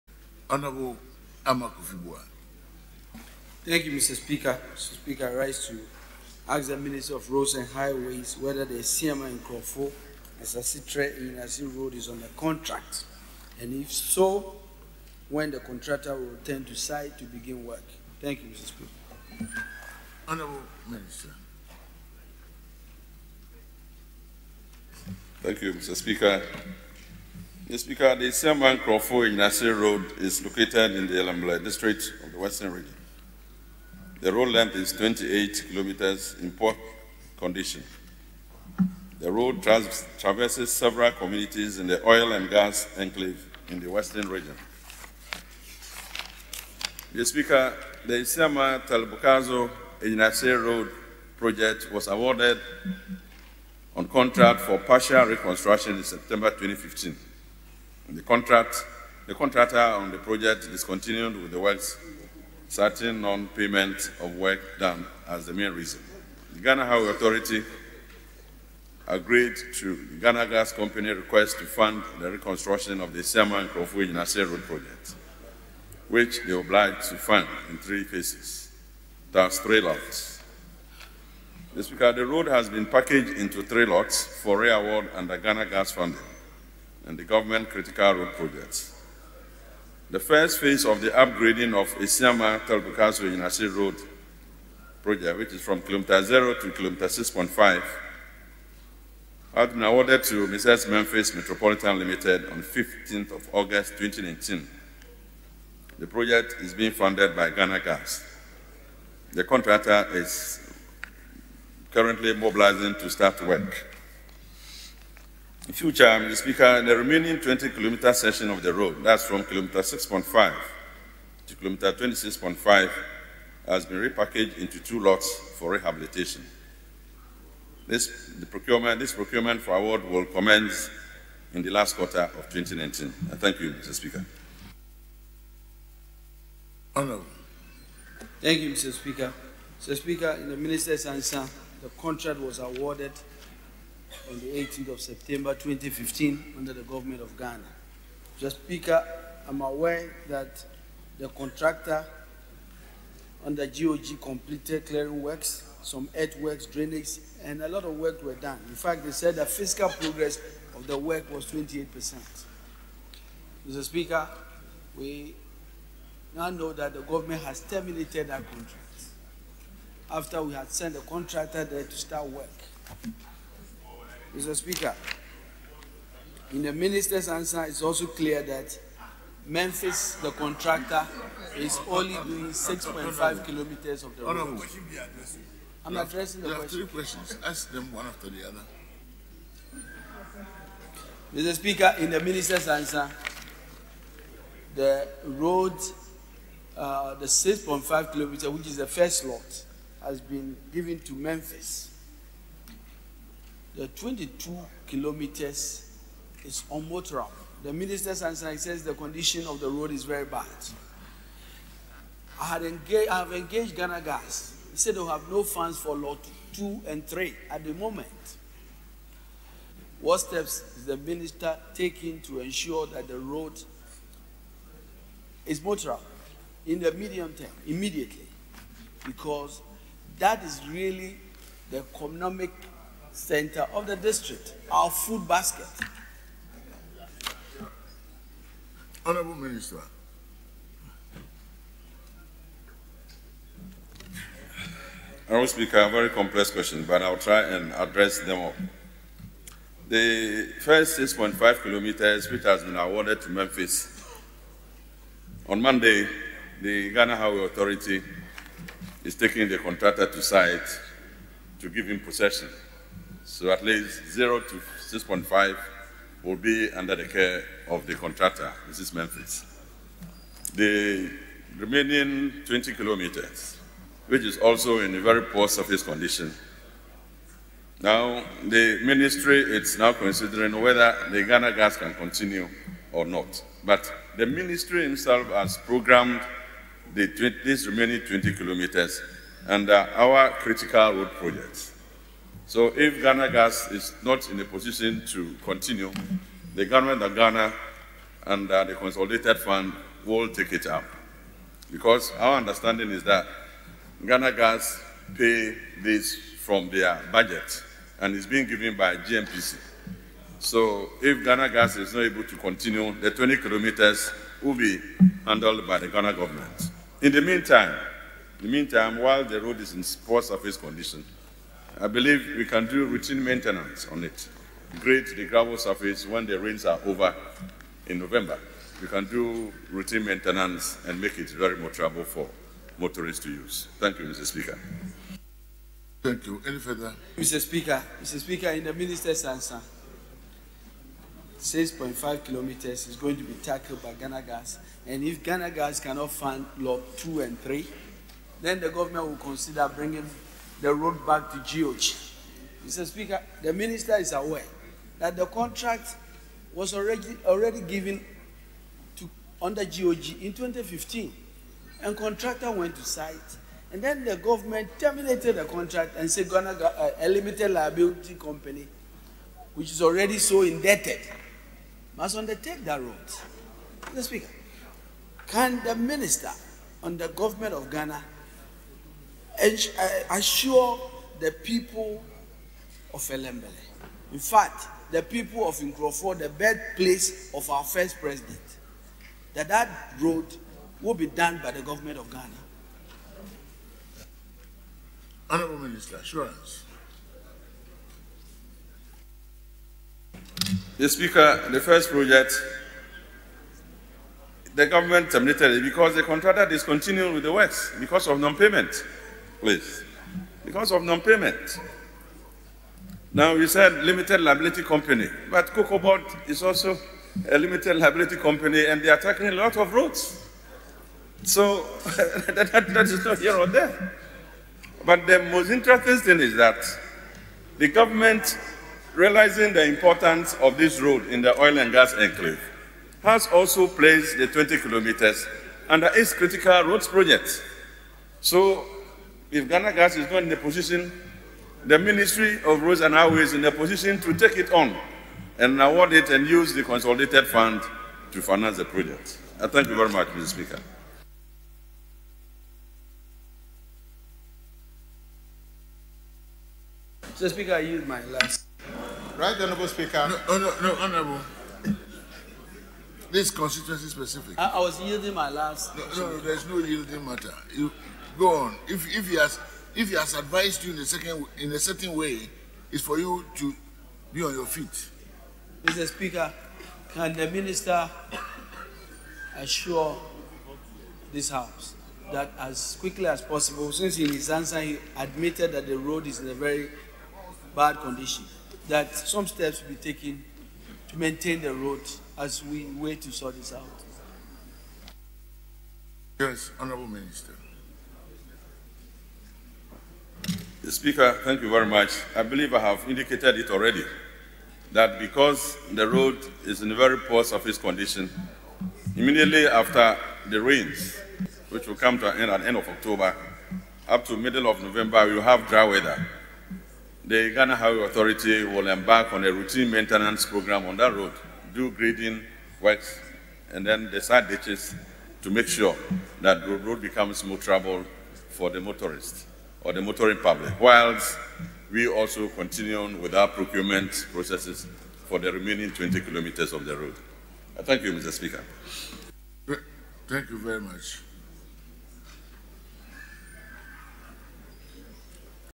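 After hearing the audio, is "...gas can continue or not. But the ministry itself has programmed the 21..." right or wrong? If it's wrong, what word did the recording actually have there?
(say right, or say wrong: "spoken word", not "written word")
wrong: "20", not "21".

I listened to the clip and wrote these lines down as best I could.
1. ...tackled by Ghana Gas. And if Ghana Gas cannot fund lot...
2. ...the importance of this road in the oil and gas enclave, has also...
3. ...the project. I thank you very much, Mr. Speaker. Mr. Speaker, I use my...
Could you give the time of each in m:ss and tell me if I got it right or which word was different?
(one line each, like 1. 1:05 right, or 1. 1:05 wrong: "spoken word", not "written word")
1. 5:43 right
2. 7:09 right
3. 7:28 right.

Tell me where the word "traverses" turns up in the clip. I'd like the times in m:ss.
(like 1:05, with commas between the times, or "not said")
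0:40.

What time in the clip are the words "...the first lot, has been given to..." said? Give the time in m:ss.
3:18.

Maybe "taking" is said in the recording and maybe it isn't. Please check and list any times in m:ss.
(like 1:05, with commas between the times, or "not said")
3:41, 4:19.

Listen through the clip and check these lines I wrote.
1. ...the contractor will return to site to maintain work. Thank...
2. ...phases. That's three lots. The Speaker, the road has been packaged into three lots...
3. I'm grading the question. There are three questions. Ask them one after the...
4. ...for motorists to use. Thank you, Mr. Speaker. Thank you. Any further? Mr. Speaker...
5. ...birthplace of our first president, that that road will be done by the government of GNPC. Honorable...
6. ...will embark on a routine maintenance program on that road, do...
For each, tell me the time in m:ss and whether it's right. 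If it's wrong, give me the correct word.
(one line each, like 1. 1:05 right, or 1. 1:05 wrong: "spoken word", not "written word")
1. 0:15 wrong: "begin", not "maintain"
2. 1:18 right
3. 3:05 wrong: "addressing", not "grading"
4. 5:32 right
5. 6:26 wrong: "Ghana", not "GNPC"
6. 8:38 right.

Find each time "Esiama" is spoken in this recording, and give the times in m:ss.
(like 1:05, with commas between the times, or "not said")
0:28, 0:48, 1:31.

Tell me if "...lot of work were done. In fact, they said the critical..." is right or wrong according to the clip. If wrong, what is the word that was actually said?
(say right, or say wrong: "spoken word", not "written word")
wrong: "fiscal", not "critical".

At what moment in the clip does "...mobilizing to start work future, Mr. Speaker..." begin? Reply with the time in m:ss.
1:52.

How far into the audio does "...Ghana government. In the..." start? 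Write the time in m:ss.
5:15.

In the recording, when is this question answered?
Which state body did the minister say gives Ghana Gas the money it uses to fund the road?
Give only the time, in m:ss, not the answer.
5:08.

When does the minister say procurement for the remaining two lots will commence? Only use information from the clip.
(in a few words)
last quarter of 2019.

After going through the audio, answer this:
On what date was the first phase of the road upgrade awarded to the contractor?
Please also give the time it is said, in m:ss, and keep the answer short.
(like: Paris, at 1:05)
15 August 2019, at 1:42.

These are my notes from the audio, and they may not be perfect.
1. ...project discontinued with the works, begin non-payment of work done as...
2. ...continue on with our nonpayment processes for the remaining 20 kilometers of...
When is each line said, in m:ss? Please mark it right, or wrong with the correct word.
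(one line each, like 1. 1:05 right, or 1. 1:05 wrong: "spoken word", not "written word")
1. 1:00 wrong: "certain", not "begin"
2. 8:52 wrong: "procurement", not "nonpayment".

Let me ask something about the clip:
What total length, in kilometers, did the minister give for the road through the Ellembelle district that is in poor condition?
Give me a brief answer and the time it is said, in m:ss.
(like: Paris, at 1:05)
28 kilometers, at 0:34.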